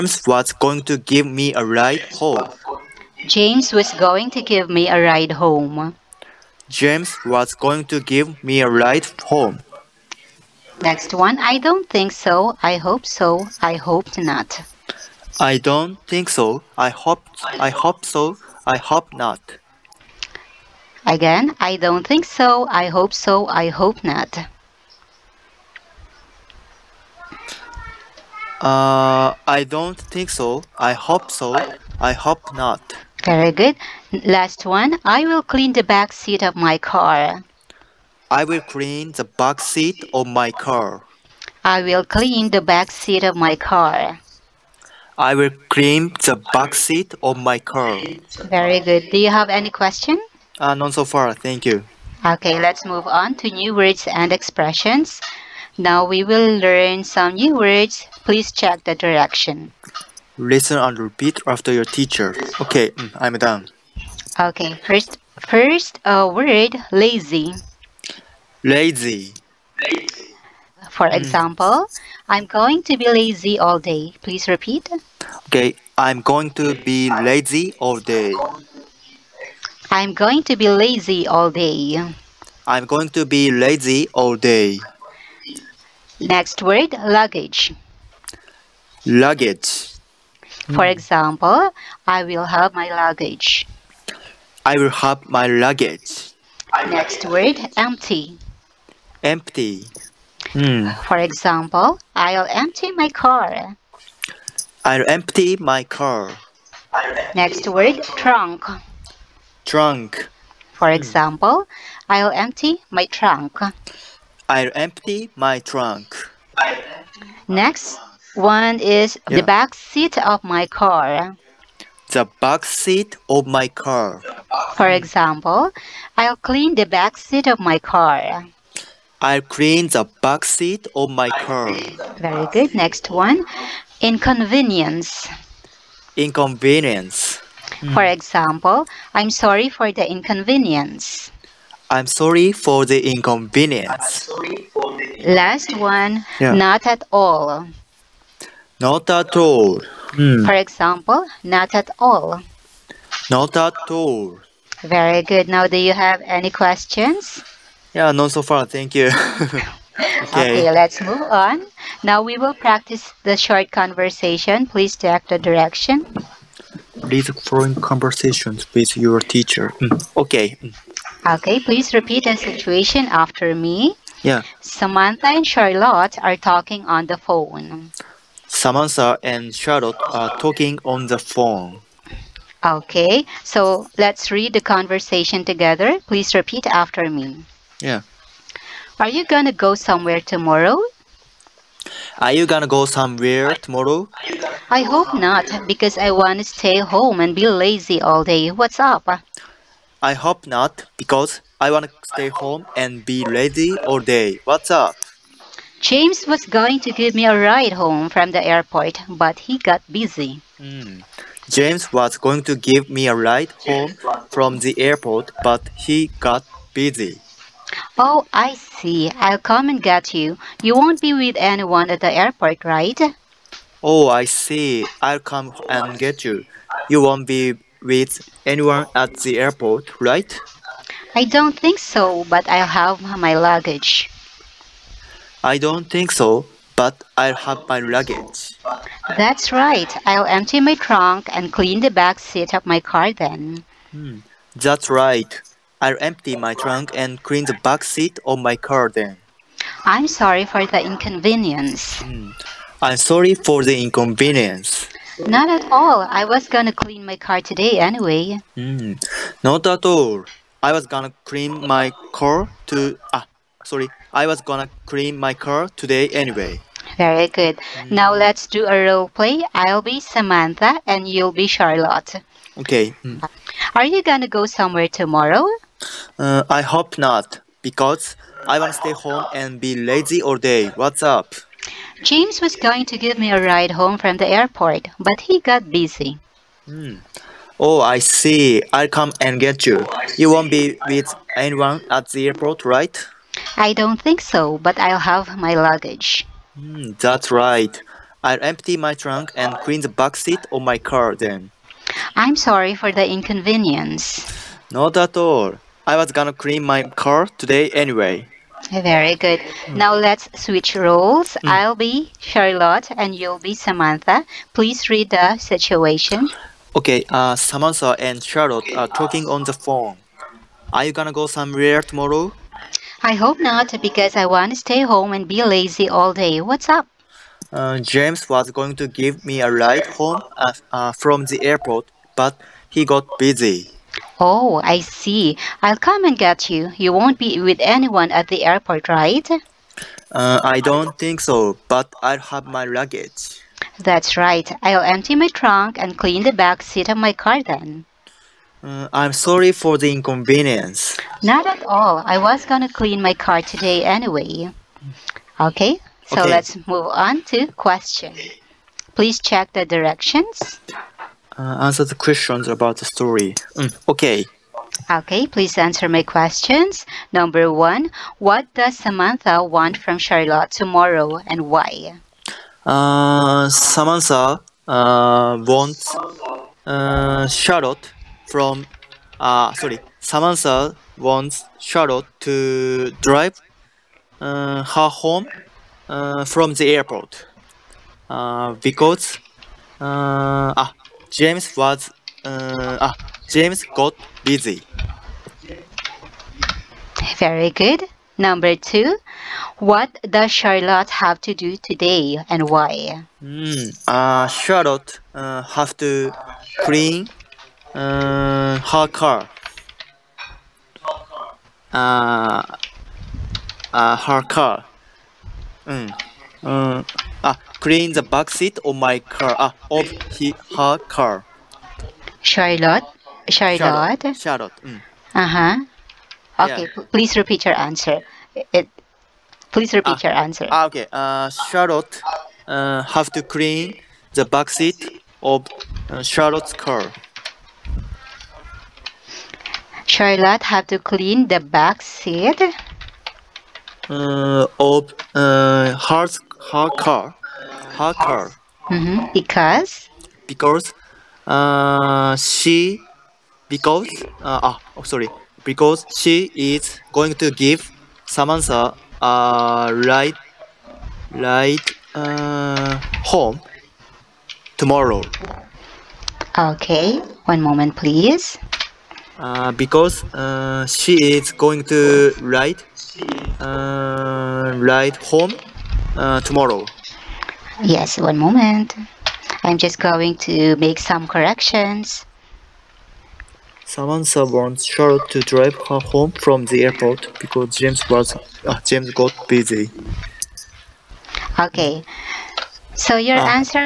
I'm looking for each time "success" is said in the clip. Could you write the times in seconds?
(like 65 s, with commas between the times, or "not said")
not said.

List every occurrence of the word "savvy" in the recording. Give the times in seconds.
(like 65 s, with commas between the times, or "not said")
not said.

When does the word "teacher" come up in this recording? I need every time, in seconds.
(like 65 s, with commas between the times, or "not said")
61 s, 169 s.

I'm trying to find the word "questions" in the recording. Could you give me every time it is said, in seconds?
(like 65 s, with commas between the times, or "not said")
49 s, 156 s, 357 s, 361 s, 366 s.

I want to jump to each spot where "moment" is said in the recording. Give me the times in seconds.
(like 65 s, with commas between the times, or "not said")
467 s, 478 s.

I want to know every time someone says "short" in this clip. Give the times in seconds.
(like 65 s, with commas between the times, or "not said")
163 s.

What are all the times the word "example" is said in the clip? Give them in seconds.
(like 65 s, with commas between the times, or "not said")
71 s, 90 s, 101 s, 110 s, 124 s, 138 s, 150 s.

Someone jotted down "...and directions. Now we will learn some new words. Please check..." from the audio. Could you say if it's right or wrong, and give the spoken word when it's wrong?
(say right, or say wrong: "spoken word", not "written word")
wrong: "expressions", not "directions".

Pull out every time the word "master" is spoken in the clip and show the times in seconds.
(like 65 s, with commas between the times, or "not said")
not said.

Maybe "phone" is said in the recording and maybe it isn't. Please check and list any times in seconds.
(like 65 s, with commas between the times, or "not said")
177 s, 181 s, 319 s.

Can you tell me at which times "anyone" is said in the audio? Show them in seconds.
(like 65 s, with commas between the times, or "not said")
221 s, 228 s, 291 s, 337 s.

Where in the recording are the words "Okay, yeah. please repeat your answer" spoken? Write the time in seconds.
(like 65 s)
426 s.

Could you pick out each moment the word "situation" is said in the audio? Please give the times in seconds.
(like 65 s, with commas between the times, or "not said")
172 s, 315 s.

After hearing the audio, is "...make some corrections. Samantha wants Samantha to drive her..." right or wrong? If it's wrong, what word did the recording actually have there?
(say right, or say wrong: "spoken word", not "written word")
wrong: "Charlotte", not "Samantha".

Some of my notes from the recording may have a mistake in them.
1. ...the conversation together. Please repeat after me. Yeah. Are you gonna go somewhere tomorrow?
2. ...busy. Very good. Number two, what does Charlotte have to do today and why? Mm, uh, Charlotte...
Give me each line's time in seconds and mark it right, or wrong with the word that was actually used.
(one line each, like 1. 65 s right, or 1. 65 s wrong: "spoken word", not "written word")
1. 184 s right
2. 394 s right.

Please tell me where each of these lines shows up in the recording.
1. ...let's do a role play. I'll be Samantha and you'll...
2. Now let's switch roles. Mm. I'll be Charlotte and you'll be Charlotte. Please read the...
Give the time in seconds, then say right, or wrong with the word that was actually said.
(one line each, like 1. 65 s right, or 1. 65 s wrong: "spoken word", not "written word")
1. 268 s right
2. 309 s wrong: "Samantha", not "Charlotte".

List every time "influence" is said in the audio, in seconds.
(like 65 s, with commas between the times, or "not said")
not said.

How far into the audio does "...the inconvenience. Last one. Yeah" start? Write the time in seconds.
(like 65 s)
144 s.